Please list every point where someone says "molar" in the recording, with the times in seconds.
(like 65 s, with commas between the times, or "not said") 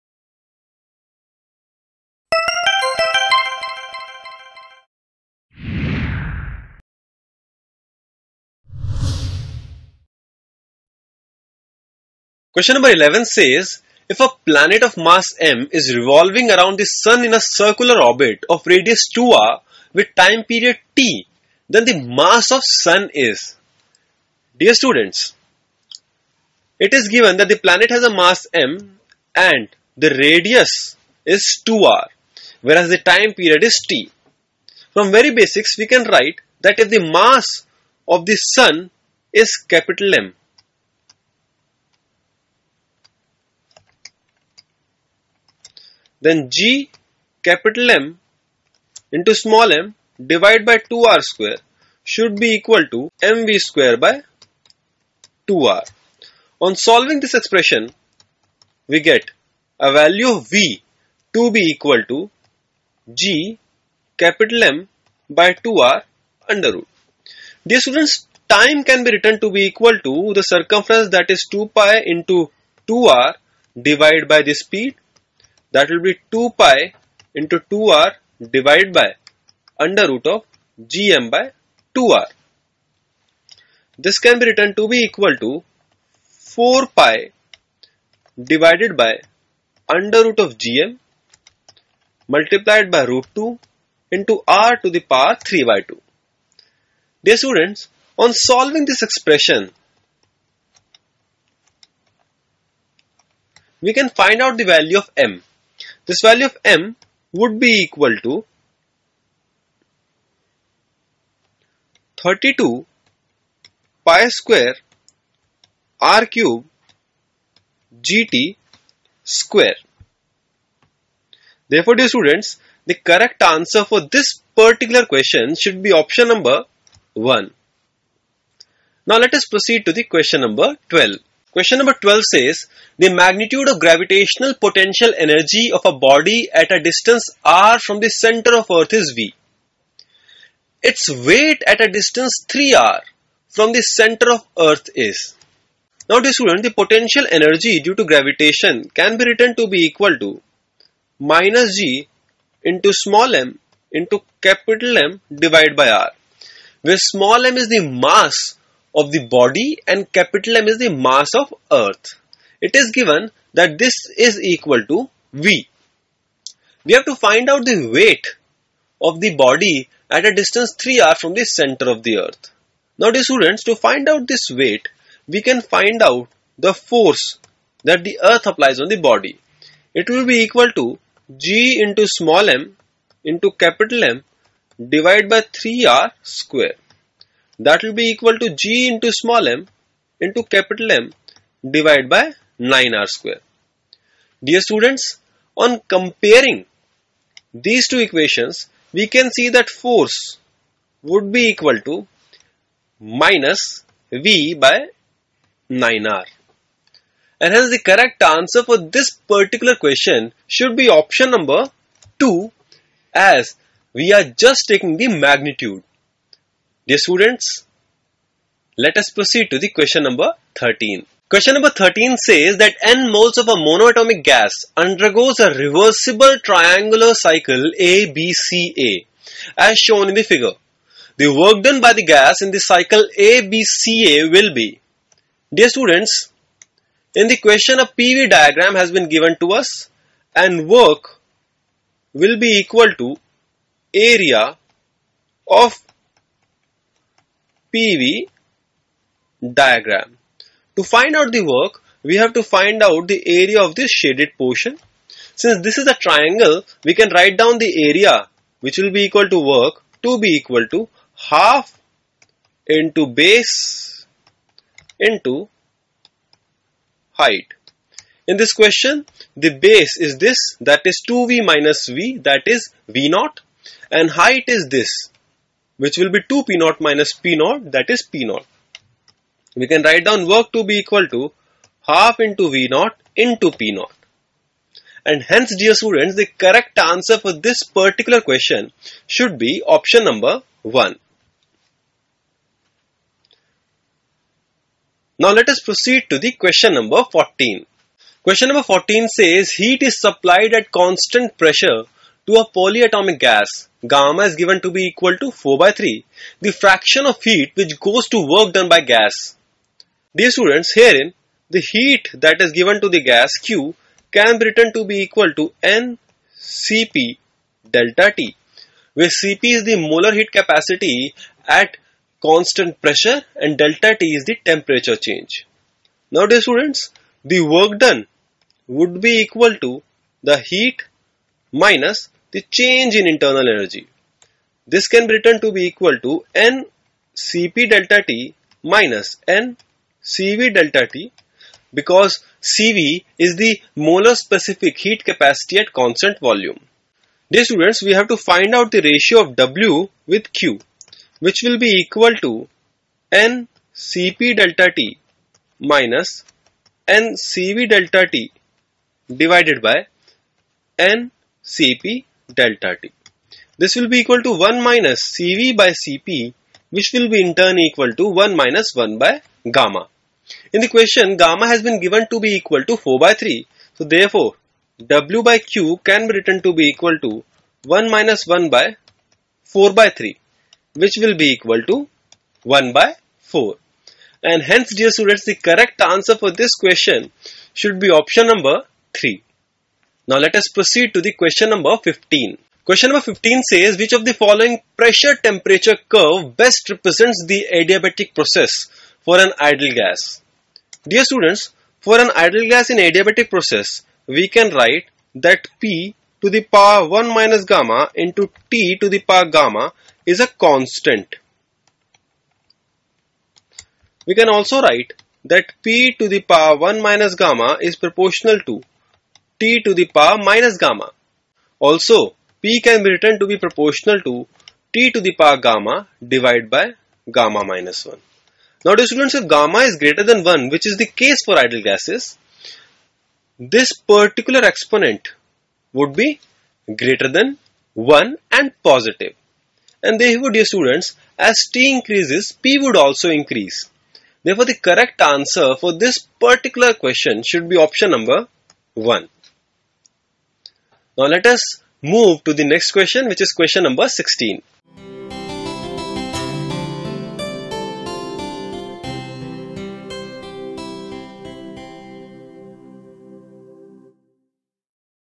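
319 s, 343 s.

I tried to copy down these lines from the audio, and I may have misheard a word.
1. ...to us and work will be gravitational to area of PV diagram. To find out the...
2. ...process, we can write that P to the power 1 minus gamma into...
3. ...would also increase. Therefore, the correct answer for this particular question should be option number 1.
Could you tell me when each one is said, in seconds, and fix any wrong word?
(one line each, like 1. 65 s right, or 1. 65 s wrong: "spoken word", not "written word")
1. 239 s wrong: "equal", not "gravitational"
2. 403 s right
3. 442 s right.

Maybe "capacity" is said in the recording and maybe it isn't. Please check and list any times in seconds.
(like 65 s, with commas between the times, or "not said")
320 s, 345 s.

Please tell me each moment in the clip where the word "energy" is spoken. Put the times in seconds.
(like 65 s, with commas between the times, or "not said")
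135 s, 147 s, 333 s.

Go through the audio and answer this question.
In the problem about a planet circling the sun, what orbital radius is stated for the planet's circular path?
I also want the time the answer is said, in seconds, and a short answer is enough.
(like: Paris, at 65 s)
2r, at 18 s.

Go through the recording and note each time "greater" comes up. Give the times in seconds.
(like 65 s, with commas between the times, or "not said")
429 s, 436 s.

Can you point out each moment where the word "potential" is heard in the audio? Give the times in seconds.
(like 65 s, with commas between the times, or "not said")
134 s, 146 s.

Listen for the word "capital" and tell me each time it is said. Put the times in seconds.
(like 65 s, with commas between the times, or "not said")
39 s, 47 s, 64 s, 154 s, 160 s, 183 s, 190 s.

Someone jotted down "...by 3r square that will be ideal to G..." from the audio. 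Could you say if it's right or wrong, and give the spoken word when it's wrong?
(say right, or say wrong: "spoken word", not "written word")
wrong: "equal", not "ideal".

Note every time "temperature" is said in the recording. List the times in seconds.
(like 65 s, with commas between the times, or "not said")
324 s, 395 s.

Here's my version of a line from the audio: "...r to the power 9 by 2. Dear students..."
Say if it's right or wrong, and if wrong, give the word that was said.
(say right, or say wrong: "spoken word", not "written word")
wrong: "3", not "9".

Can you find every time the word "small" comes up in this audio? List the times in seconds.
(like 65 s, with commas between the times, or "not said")
49 s, 152 s, 157 s, 182 s, 189 s.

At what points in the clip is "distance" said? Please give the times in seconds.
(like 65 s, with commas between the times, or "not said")
136 s, 141 s, 170 s.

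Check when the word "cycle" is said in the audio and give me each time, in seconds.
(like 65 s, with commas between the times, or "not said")
227 s, 232 s.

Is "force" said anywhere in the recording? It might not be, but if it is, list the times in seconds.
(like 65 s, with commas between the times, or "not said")
176 s, 199 s.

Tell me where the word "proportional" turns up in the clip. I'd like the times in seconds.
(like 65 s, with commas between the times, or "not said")
417 s, 423 s.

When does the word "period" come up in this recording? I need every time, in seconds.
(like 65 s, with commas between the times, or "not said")
20 s, 33 s.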